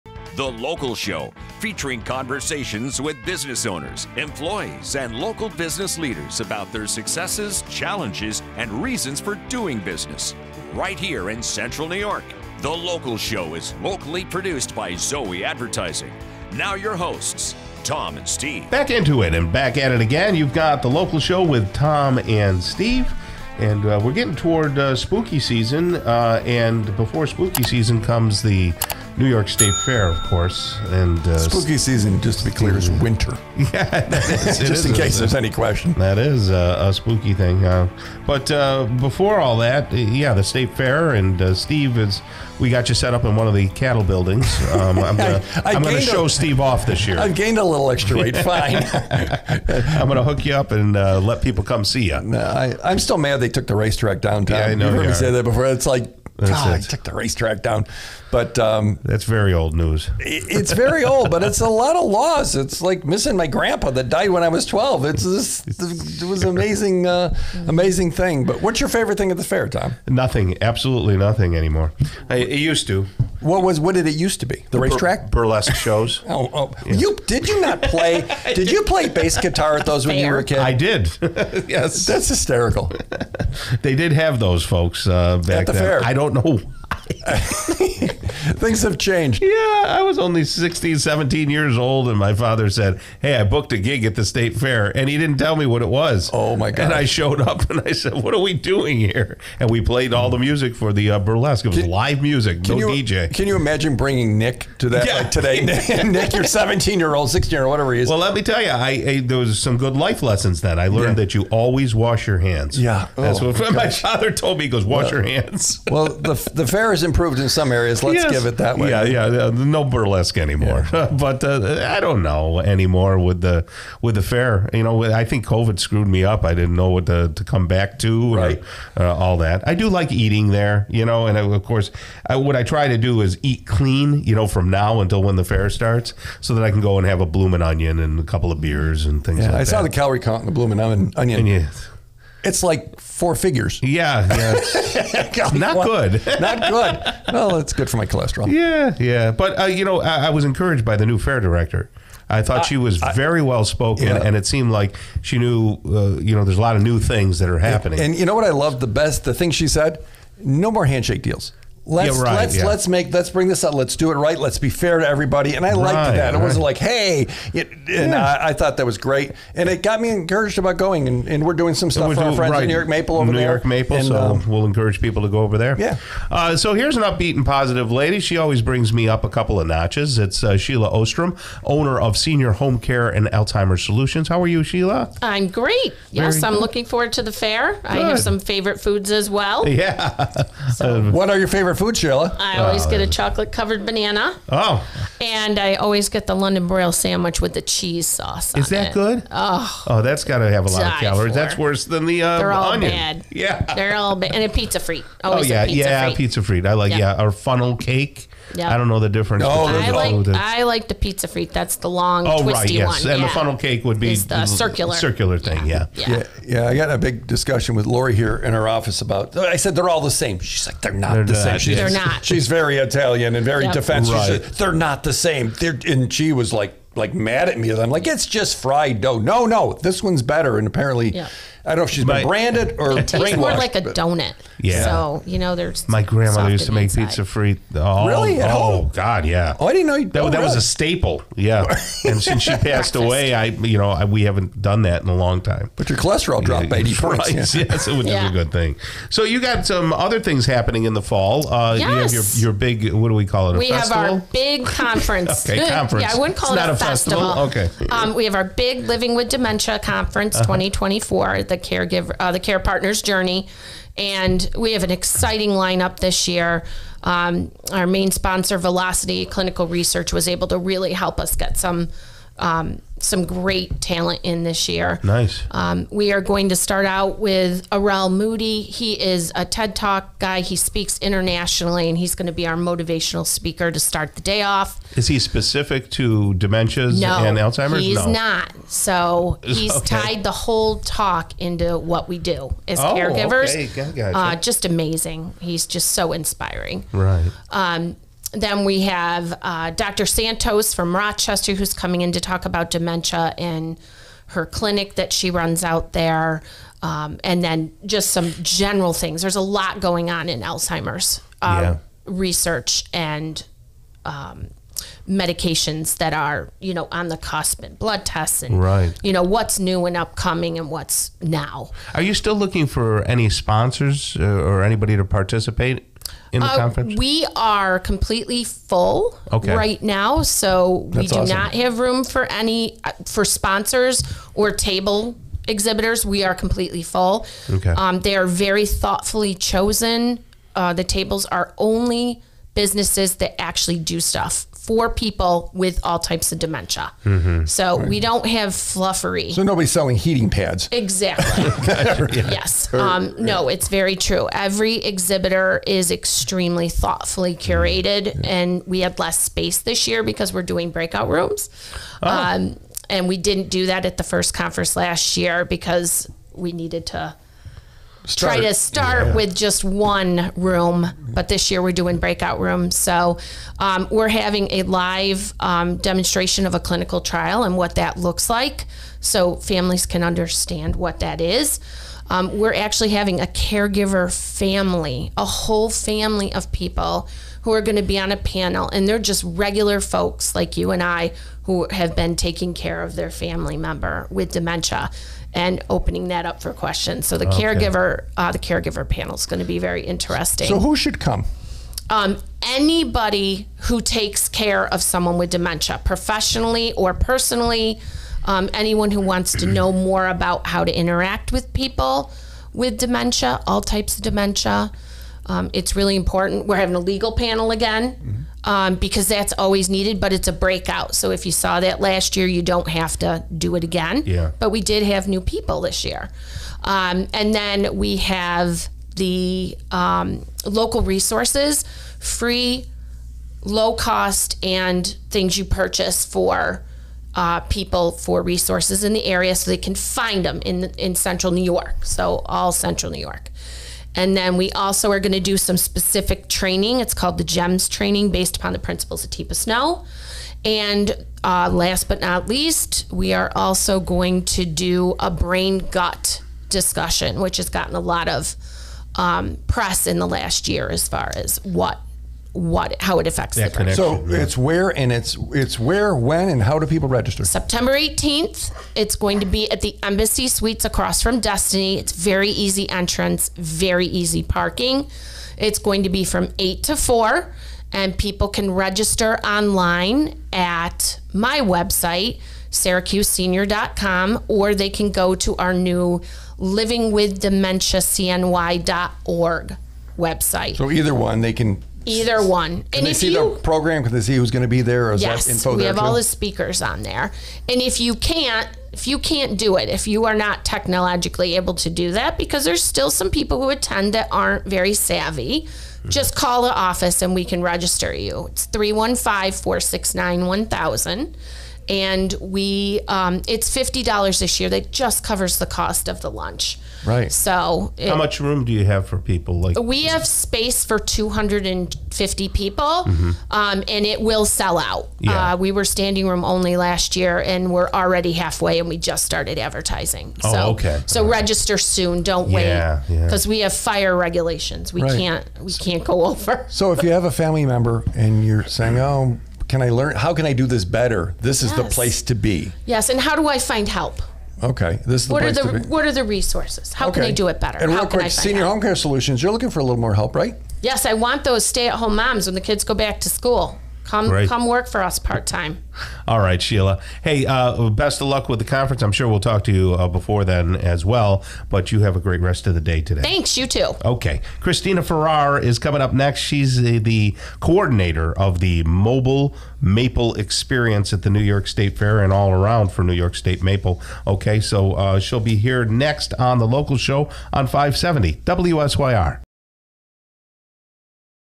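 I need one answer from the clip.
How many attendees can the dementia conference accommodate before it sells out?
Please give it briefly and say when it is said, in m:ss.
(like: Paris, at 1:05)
250, at 8:40.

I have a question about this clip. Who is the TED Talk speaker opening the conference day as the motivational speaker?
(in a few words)
Arel Moodie.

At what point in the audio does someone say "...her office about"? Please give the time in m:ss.
3:38.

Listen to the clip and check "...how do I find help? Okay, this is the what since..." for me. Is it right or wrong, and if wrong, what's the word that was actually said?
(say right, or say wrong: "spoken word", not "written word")
wrong: "place", not "since".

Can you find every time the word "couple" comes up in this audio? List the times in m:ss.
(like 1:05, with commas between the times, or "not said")
2:18, 2:59.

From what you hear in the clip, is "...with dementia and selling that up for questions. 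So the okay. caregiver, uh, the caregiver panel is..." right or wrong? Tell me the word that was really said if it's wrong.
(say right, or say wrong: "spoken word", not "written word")
wrong: "opening", not "selling".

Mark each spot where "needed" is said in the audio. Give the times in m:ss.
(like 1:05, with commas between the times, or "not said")
6:06, 6:59.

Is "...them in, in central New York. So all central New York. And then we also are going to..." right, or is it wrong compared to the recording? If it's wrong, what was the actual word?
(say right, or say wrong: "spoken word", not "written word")
right.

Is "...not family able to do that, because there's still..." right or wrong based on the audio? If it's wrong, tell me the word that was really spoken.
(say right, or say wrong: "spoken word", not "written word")
wrong: "technologically", not "family".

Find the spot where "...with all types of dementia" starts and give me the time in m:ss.
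5:45.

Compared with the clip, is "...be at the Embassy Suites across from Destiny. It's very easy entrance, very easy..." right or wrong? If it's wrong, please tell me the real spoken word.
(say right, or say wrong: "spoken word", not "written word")
right.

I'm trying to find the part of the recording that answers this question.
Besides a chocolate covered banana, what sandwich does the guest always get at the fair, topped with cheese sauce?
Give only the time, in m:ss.
3:16.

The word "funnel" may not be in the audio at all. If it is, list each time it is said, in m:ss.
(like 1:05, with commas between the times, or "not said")
3:27, 3:33.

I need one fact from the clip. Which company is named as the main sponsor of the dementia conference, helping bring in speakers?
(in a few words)
Velocity Clinical Research.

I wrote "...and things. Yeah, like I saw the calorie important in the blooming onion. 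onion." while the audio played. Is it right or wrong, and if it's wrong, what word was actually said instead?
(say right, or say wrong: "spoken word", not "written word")
wrong: "count", not "important".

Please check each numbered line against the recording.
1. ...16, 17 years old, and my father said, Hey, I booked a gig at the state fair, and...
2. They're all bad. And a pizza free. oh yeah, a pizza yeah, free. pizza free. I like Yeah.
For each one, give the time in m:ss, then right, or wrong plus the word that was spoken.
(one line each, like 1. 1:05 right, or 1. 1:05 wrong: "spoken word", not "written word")
1. 1:30 right
2. 3:23 right.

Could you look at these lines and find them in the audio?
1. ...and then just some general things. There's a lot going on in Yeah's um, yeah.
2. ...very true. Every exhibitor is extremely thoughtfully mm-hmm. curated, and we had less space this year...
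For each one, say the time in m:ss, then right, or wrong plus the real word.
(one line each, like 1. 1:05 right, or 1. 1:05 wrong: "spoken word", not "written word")
1. 5:07 wrong: "Alzheimer", not "Yeah"
2. 5:53 right.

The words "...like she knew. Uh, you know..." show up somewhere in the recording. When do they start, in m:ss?
2:34.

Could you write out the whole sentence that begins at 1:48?
Well, let me tell you, I, I there was some good life lessons then.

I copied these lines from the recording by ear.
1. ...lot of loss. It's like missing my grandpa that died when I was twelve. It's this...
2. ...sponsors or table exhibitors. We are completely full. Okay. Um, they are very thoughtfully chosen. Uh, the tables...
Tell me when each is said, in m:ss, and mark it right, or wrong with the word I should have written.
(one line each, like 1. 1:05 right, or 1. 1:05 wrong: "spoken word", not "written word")
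1. 1:01 right
2. 5:33 right.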